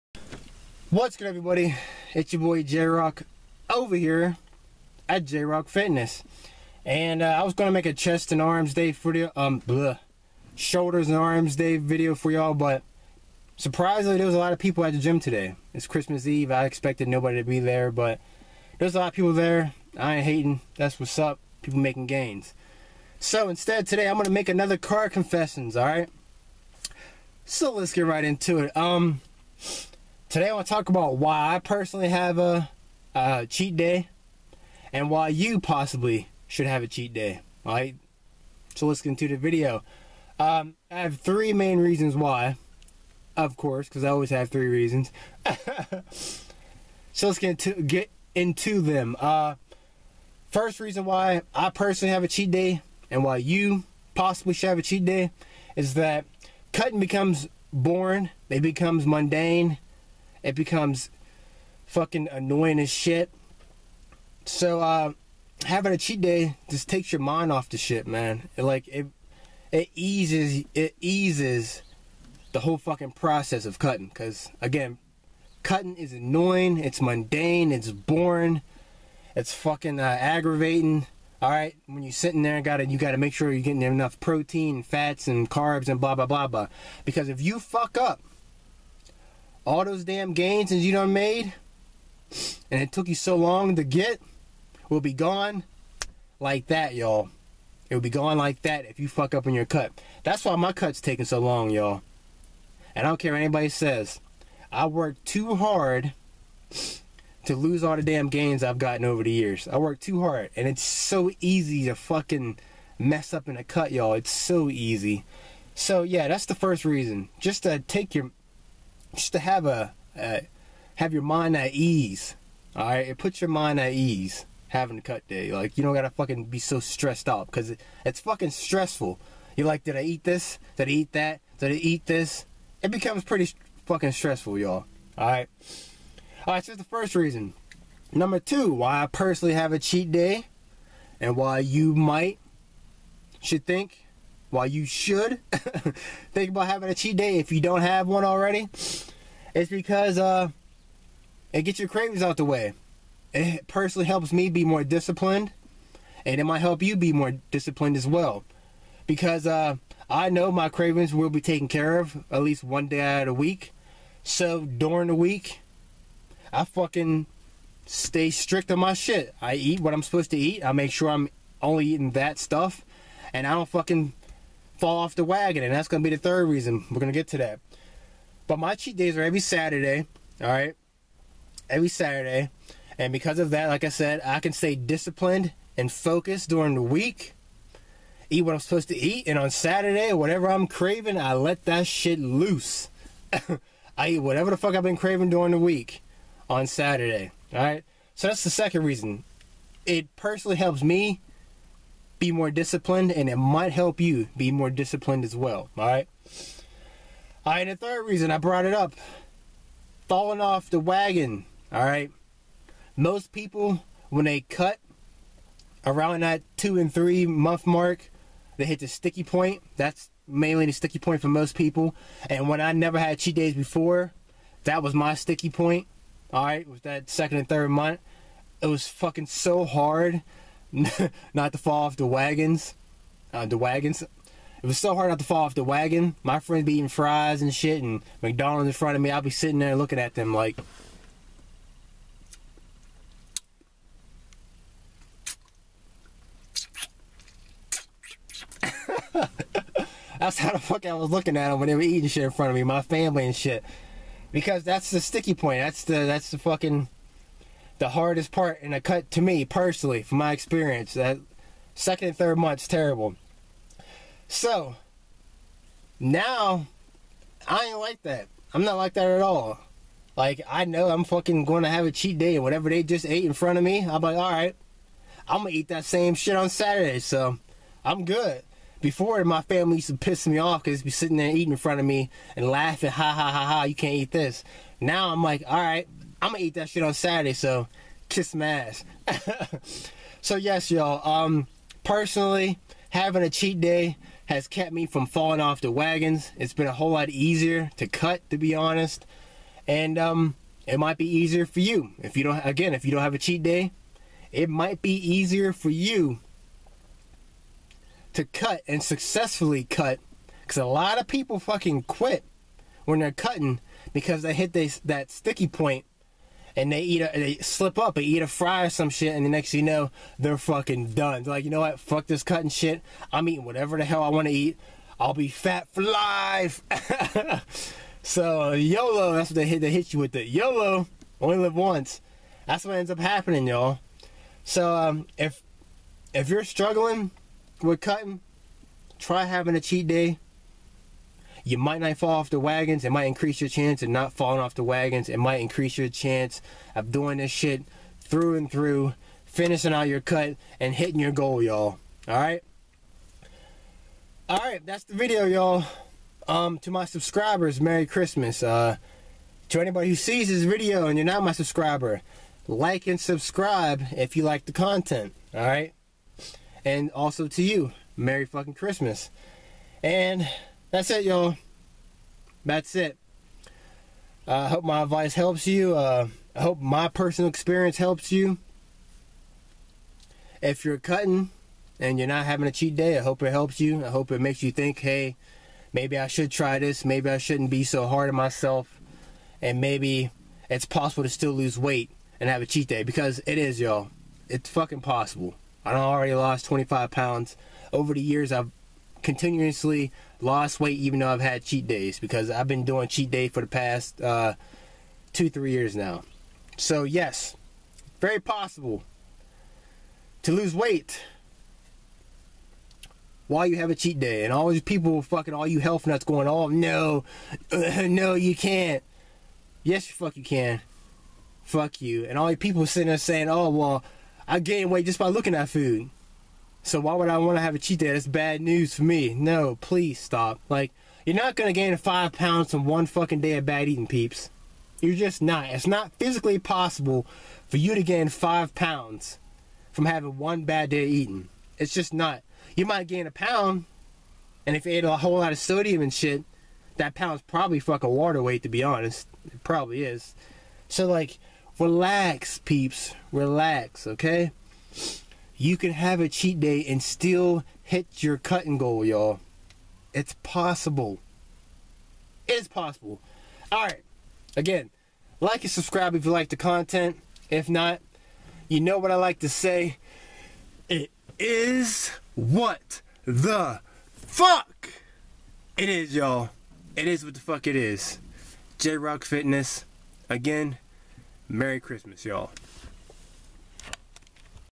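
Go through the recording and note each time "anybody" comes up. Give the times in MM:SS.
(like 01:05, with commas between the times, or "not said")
01:43, 05:59.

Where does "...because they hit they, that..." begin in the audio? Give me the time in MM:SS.
05:13.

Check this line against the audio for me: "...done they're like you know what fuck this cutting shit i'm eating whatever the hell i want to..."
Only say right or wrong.
right.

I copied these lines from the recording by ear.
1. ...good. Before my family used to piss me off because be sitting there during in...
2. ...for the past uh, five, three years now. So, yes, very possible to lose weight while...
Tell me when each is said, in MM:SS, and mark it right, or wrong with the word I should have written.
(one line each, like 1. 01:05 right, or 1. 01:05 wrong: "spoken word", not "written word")
1. 04:38 wrong: "eating", not "during"
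2. 06:43 wrong: "two", not "five".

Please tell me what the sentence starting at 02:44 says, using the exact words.
So during the week, I fucking stay strict on my shit.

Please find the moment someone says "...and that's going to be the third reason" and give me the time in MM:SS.
02:55.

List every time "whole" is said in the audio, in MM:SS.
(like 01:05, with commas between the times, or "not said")
01:12, 04:56, 07:24.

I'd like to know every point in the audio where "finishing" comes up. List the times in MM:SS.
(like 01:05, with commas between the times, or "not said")
05:49.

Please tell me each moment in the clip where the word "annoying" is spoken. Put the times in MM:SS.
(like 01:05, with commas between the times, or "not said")
01:02, 01:16.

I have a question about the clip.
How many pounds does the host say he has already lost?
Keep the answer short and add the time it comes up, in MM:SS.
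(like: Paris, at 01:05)
25, at 06:36.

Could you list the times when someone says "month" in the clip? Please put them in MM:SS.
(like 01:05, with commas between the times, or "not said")
03:37, 03:47, 04:22.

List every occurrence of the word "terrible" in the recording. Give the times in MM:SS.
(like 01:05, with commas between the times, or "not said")
04:22.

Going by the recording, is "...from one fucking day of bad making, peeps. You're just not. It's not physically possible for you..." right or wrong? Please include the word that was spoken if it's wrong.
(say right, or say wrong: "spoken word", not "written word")
wrong: "eating", not "making".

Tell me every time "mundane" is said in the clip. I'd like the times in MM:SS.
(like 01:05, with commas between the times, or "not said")
00:59, 01:17.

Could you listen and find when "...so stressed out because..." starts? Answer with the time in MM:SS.
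02:06.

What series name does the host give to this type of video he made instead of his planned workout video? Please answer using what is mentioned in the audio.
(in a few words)
car confessions.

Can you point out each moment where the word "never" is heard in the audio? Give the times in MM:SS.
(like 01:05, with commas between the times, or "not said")
03:42.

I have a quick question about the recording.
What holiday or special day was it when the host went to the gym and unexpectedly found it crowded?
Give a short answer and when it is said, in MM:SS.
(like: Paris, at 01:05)
Christmas Eve, at 00:15.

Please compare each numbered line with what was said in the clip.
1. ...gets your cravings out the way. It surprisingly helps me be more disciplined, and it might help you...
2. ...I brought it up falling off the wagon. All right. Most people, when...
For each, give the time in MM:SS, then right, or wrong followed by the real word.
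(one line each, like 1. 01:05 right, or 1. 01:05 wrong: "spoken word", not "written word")
1. 02:31 wrong: "personally", not "surprisingly"
2. 03:28 right.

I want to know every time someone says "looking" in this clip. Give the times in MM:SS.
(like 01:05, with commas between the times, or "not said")
03:59, 04:11, 07:05.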